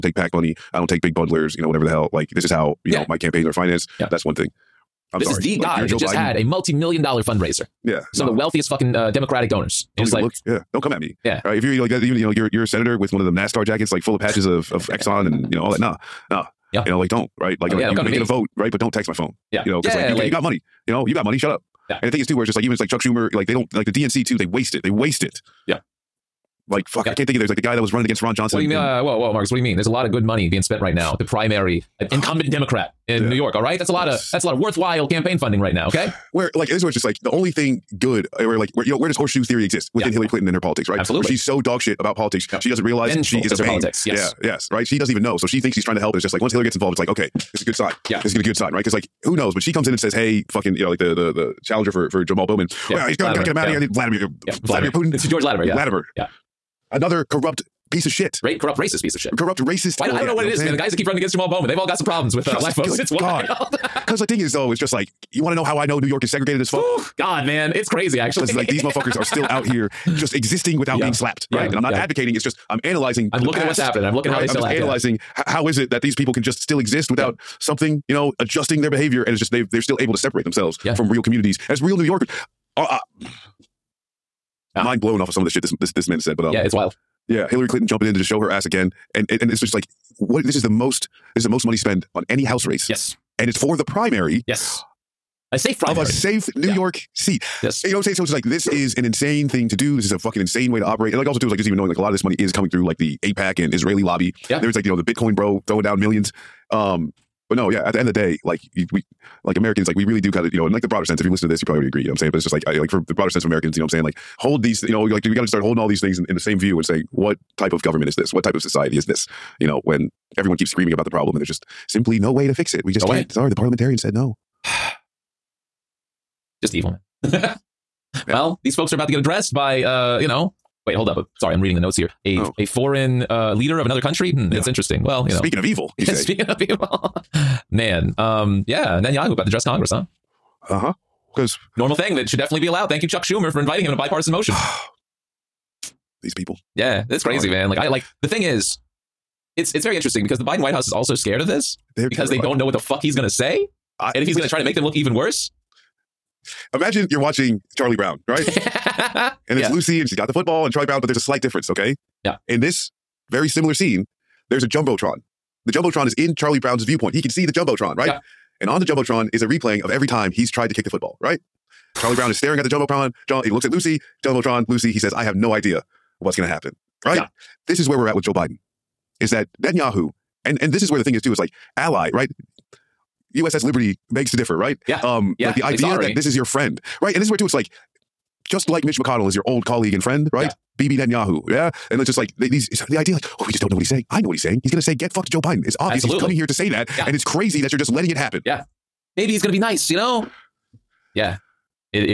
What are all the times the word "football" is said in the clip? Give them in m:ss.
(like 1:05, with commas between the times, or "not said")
2:40, 2:50.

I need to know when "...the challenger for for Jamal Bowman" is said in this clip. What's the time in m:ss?
0:51.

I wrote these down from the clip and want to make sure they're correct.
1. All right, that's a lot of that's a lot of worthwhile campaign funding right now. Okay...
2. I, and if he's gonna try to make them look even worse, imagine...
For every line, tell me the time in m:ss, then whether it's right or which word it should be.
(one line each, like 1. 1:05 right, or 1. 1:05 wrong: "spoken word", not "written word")
1. 0:33 right
2. 2:34 right.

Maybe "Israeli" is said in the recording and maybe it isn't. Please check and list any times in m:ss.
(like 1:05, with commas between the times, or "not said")
1:43.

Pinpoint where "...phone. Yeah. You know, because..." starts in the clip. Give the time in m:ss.
0:19.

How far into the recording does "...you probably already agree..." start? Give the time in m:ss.
1:51.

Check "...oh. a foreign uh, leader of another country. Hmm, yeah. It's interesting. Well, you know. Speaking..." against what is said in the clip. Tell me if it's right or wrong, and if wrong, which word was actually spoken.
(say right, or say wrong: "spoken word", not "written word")
right.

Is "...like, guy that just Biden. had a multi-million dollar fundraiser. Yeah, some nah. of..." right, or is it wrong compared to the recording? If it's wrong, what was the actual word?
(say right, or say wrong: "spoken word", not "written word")
right.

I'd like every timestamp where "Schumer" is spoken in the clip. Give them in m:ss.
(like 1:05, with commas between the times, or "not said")
0:22, 2:23.